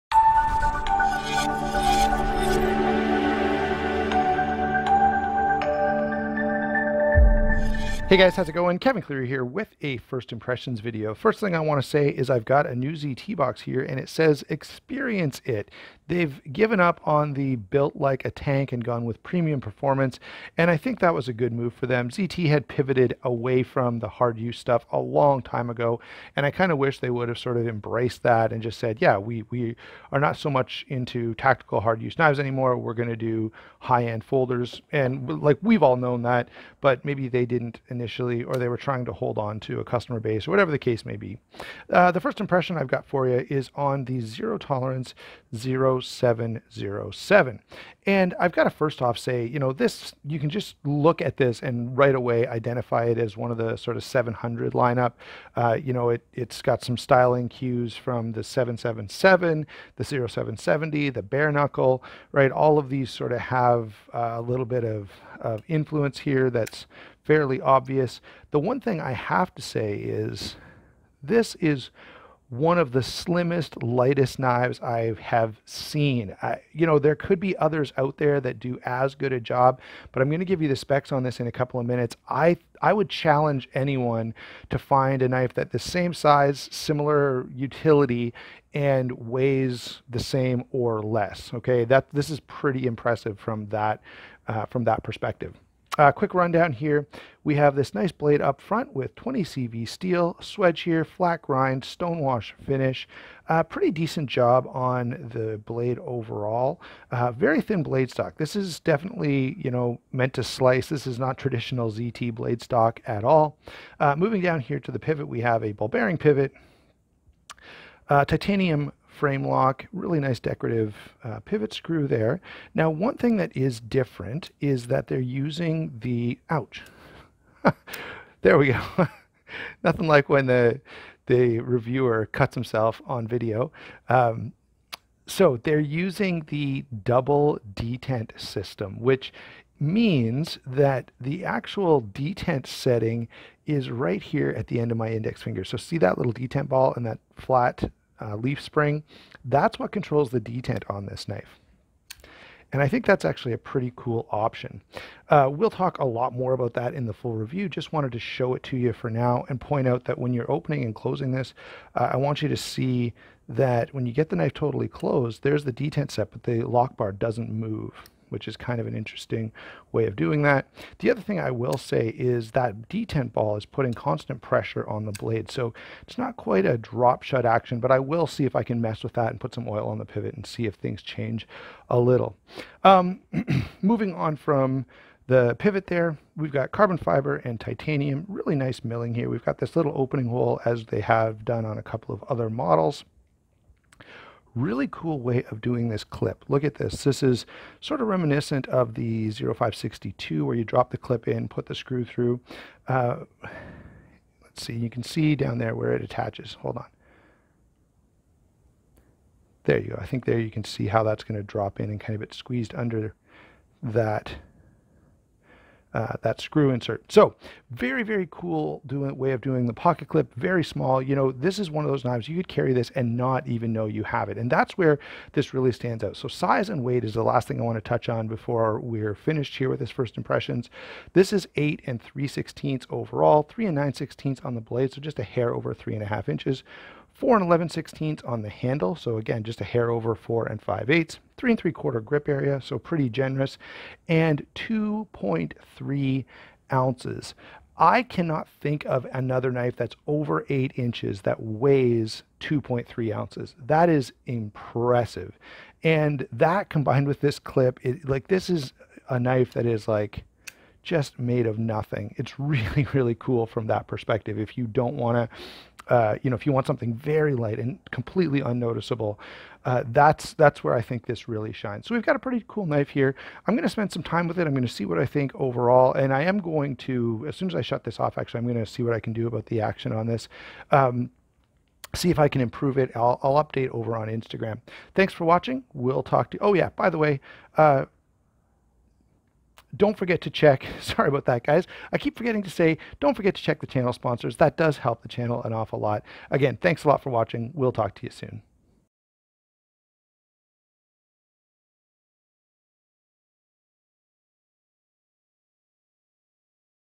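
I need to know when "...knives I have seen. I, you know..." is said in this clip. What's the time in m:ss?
1:14.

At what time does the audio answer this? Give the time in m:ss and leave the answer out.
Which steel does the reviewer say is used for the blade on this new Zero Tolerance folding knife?
1:39.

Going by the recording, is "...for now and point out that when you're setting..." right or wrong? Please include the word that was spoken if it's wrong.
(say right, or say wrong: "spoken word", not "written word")
wrong: "opening", not "setting".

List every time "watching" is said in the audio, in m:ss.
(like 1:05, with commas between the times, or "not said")
4:45, 4:57.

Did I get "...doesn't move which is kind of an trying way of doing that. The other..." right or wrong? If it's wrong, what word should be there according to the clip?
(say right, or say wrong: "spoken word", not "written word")
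wrong: "interesting", not "trying".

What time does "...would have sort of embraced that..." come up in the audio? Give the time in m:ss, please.
0:27.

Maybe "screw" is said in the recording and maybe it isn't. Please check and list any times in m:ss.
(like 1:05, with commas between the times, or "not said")
2:01, 3:21, 3:36.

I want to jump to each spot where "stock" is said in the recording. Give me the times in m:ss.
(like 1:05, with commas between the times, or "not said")
1:48, 1:52.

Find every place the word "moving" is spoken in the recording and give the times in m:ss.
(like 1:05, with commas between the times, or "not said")
1:54, 3:03.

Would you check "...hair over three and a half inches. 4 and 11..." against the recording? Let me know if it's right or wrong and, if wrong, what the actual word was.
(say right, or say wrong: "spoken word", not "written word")
right.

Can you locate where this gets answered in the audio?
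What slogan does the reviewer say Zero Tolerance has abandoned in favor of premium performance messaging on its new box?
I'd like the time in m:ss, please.
0:17.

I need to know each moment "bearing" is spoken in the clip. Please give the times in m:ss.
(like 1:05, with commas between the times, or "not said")
1:55.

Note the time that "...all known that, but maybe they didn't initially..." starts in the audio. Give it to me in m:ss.
0:35.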